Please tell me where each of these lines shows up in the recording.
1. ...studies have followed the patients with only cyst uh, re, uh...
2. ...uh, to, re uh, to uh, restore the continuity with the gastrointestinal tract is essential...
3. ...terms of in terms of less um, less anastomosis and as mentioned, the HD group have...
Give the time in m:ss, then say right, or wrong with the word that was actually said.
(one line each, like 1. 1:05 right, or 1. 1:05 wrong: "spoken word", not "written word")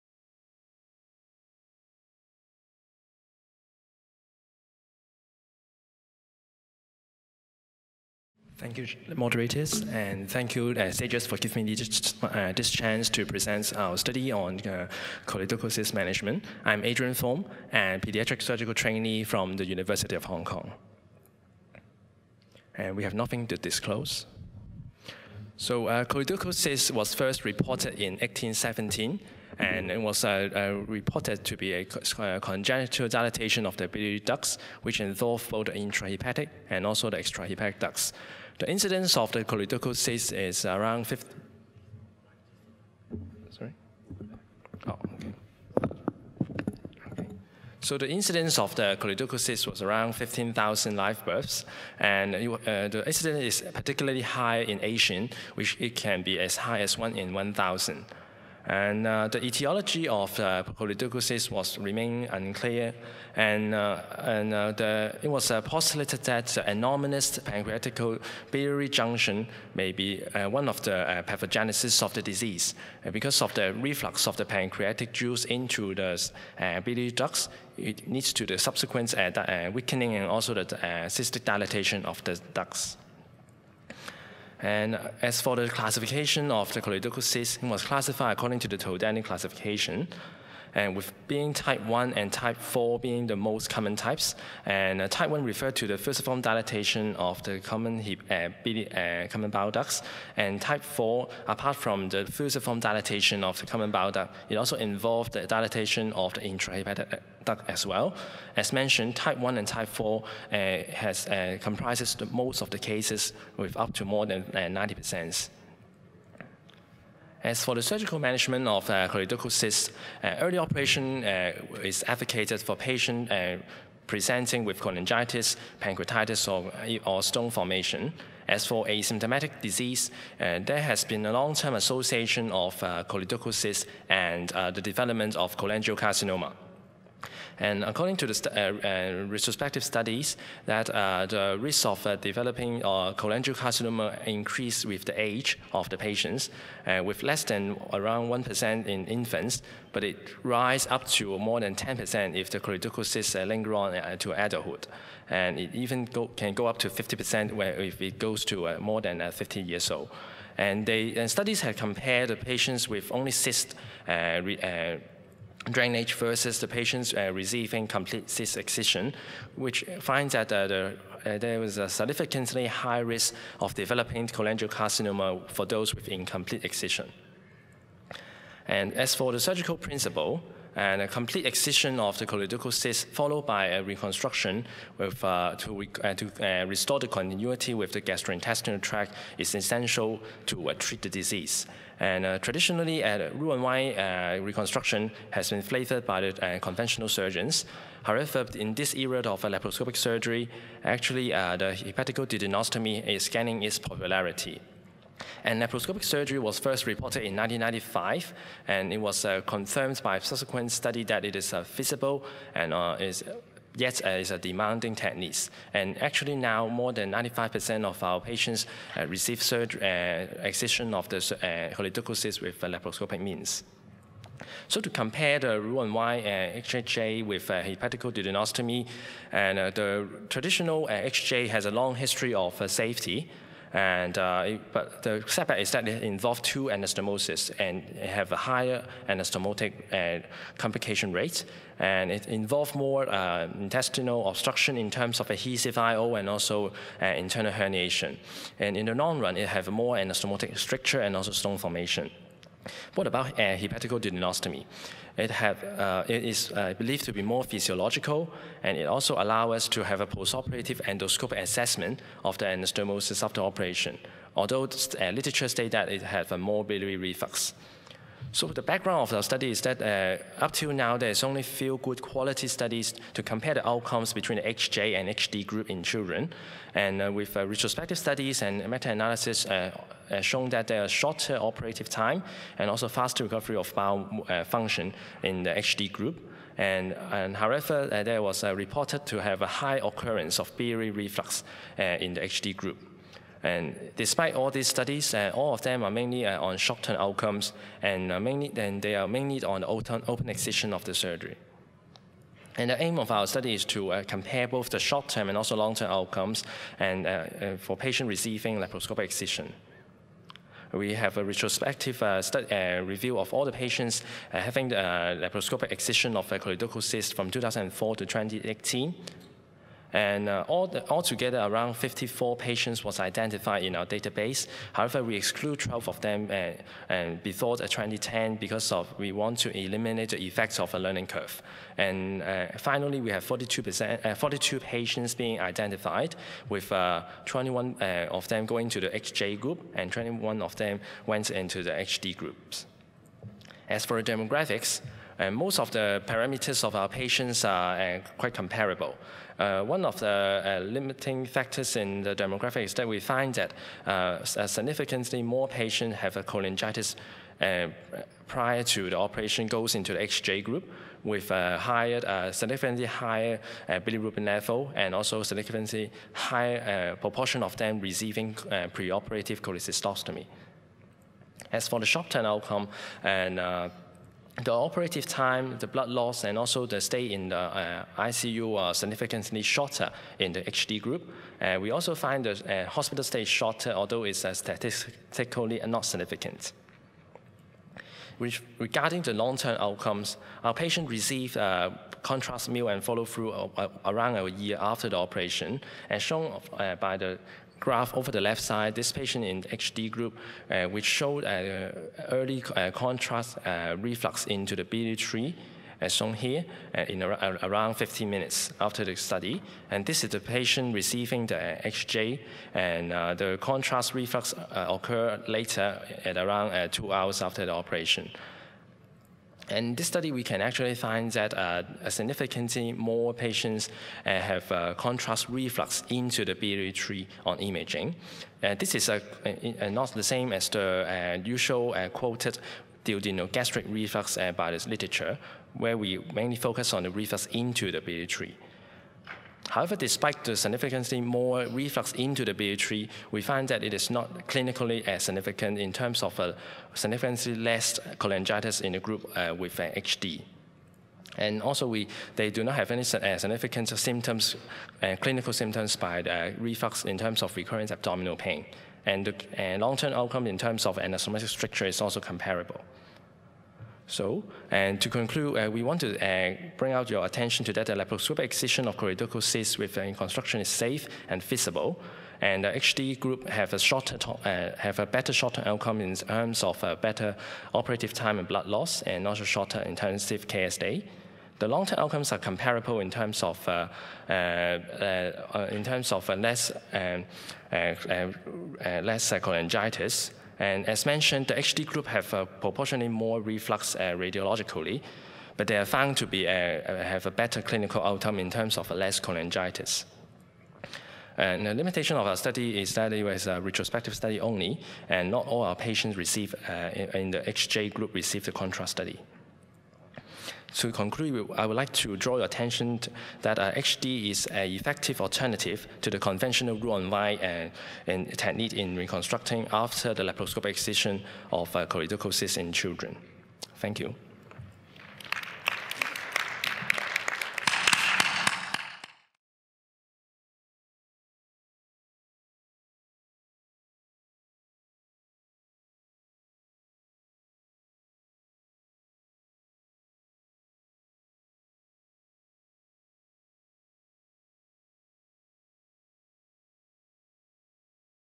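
1. 2:41 wrong: "compared", not "followed"
2. 3:05 right
3. 8:02 wrong: "cholangitis", not "anastomosis".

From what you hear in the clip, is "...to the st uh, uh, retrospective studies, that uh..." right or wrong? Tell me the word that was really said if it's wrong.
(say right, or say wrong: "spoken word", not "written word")
right.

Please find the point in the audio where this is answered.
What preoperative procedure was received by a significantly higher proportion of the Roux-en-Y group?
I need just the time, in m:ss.
6:09.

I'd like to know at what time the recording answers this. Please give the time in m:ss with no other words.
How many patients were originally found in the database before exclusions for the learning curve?
5:21.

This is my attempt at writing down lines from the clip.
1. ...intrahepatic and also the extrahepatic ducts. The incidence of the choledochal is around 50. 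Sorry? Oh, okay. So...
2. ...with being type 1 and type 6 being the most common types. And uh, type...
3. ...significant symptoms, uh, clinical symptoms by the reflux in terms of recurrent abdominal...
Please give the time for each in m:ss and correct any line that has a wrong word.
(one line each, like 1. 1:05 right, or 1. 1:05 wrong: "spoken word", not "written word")
1. 0:35 right
2. 1:30 wrong: "4", not "6"
3. 7:33 right.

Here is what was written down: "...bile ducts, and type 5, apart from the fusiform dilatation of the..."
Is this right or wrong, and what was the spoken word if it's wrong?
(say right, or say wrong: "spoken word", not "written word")
wrong: "4", not "5".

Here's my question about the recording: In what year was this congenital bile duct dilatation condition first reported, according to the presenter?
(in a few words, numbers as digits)
1817.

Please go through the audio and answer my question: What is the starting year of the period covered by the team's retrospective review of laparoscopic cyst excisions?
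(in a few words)
2004.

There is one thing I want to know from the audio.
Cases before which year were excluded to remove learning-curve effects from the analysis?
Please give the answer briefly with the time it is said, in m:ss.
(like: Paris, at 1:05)
2010, at 5:27.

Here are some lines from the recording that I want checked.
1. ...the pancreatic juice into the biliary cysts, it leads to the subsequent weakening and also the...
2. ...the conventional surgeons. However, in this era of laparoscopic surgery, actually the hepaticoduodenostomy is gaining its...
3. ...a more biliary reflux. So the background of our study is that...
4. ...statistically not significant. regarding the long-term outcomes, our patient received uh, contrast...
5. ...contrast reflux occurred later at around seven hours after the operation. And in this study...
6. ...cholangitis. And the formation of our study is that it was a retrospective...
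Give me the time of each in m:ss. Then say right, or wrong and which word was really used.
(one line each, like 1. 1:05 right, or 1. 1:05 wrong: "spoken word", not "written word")
1. 1:14 wrong: "ducts", not "cysts"
2. 3:16 right
3. 4:26 right
4. 6:24 right
5. 6:53 wrong: "two", not "seven"
6. 8:18 wrong: "limitation", not "formation".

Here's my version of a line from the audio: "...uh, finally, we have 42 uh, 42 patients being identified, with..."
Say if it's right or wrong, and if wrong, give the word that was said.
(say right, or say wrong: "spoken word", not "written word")
right.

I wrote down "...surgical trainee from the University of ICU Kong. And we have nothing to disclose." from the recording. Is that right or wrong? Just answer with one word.
wrong.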